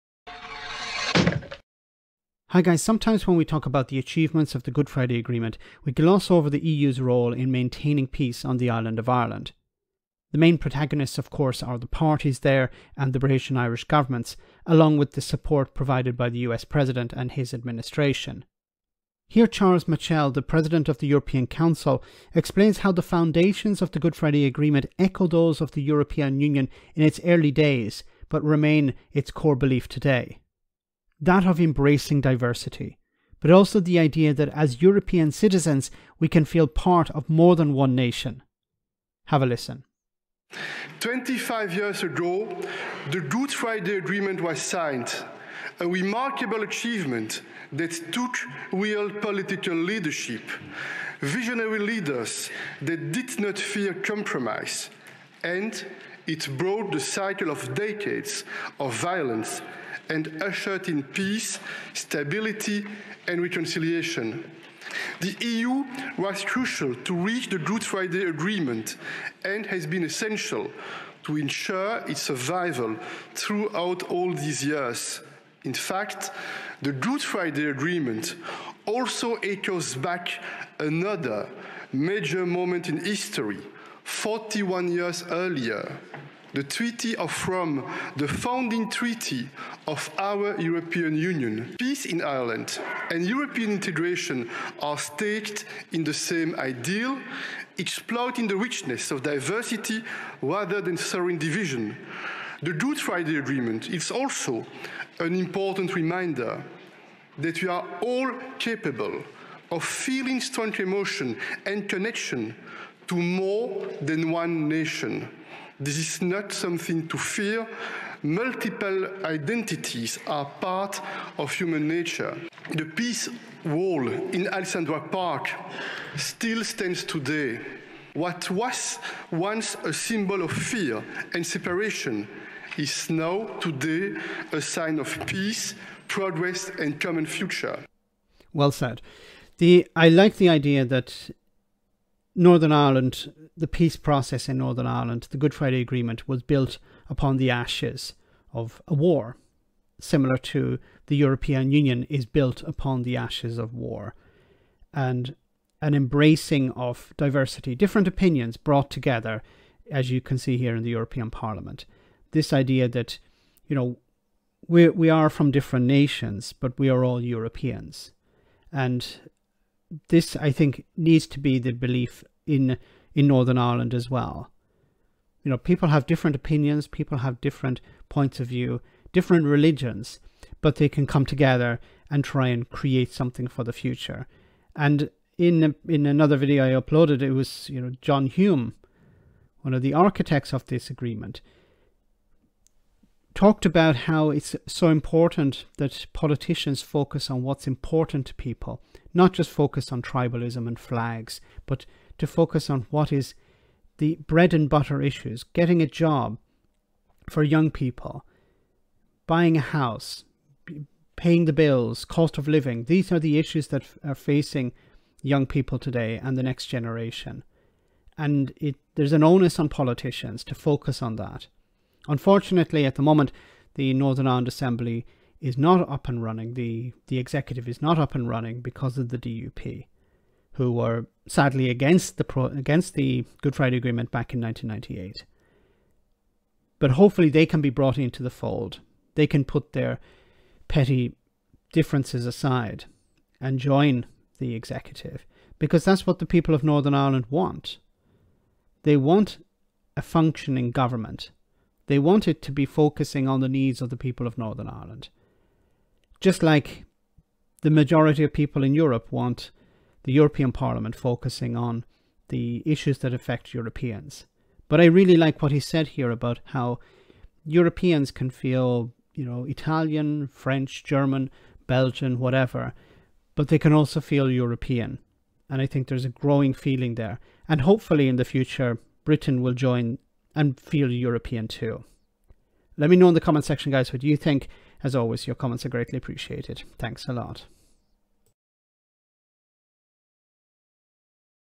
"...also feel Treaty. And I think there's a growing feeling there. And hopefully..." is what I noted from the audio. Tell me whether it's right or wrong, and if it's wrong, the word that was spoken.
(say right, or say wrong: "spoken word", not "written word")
wrong: "European", not "Treaty".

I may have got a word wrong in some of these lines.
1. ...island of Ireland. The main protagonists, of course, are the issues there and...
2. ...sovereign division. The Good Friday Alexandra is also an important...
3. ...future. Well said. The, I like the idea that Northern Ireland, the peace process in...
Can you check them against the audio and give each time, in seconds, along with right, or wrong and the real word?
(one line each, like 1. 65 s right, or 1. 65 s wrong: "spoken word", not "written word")
1. 8 s wrong: "parties", not "issues"
2. 100 s wrong: "Agreement", not "Alexandra"
3. 137 s right.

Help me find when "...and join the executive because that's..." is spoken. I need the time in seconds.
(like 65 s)
243 s.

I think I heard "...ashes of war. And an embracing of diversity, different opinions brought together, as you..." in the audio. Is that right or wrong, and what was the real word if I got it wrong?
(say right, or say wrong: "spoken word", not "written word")
right.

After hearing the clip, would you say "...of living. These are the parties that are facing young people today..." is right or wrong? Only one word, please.
wrong.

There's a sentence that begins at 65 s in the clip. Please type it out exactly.
The EU was crucial to reach the Good Friday Agreement and has been essential to ensure its survival throughout all these years.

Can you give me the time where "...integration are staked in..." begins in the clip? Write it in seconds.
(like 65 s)
93 s.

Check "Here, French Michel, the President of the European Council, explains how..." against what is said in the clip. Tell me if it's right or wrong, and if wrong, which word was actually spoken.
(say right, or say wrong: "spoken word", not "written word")
wrong: "Charles", not "French".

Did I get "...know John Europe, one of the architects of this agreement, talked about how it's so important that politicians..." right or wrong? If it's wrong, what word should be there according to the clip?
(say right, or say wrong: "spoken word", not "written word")
wrong: "Hume", not "Europe".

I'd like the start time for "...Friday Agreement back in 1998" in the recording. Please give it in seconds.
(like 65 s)
233 s.